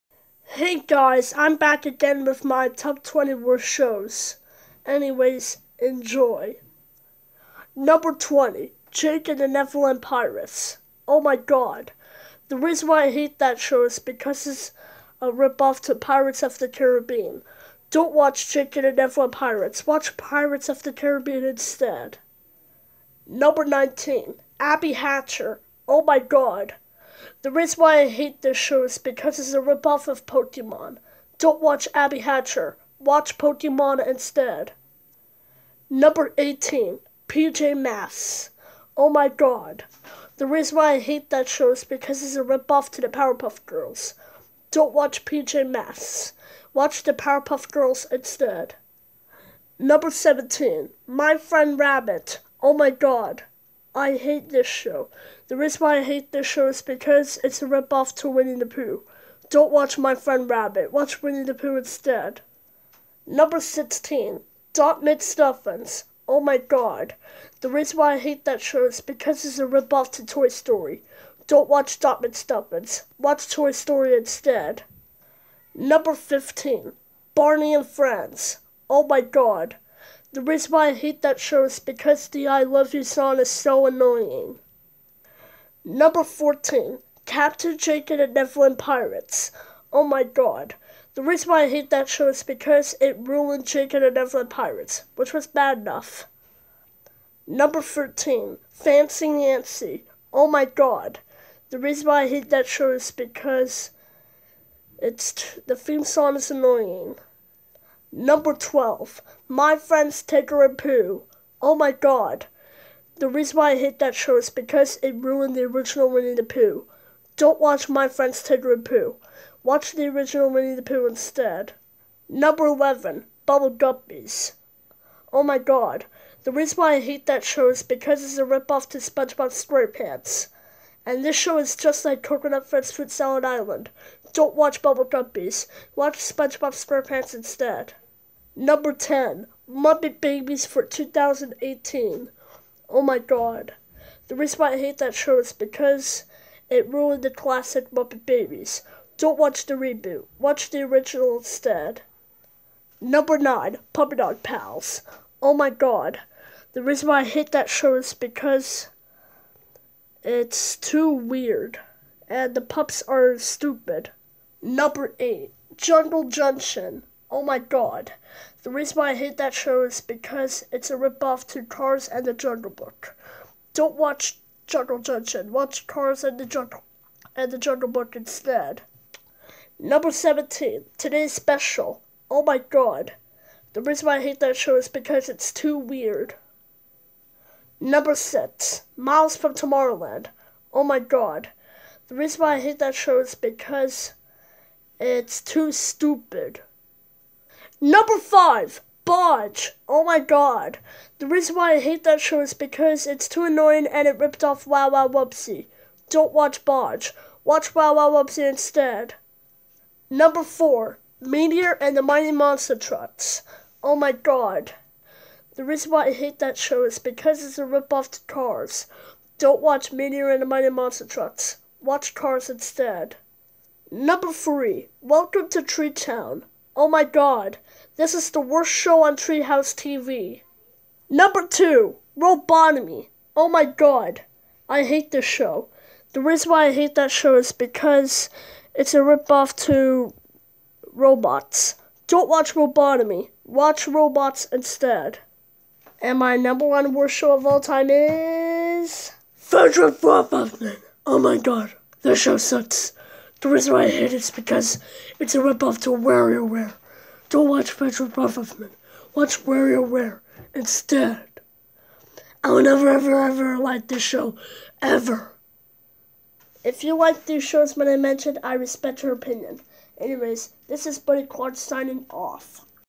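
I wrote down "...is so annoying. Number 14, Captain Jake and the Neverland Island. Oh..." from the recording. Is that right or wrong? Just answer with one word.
wrong.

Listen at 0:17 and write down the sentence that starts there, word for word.
Don't watch Jake and the Neverland Pirates.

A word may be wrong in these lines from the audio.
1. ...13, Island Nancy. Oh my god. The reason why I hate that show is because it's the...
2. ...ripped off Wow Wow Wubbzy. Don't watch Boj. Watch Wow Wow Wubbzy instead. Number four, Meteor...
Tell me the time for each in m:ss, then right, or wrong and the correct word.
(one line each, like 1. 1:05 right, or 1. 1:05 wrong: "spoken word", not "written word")
1. 1:37 wrong: "Fancy", not "Island"
2. 3:24 right.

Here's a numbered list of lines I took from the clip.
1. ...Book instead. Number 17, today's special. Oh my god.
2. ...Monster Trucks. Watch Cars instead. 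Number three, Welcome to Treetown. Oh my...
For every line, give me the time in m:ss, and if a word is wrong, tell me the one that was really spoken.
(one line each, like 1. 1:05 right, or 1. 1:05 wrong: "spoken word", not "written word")
1. 2:57 right
2. 3:40 right.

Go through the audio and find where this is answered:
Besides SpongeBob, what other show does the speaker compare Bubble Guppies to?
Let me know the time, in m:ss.
2:12.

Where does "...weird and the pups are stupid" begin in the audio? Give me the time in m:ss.
2:41.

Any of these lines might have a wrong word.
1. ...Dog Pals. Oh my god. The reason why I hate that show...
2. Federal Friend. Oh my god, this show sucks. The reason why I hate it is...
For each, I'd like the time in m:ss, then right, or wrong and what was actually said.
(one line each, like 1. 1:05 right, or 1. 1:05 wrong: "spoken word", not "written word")
1. 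2:34 right
2. 4:09 wrong: "Robotman", not "Friend".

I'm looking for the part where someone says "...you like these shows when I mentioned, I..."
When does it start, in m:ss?
4:26.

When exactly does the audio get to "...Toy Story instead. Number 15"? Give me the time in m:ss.
1:13.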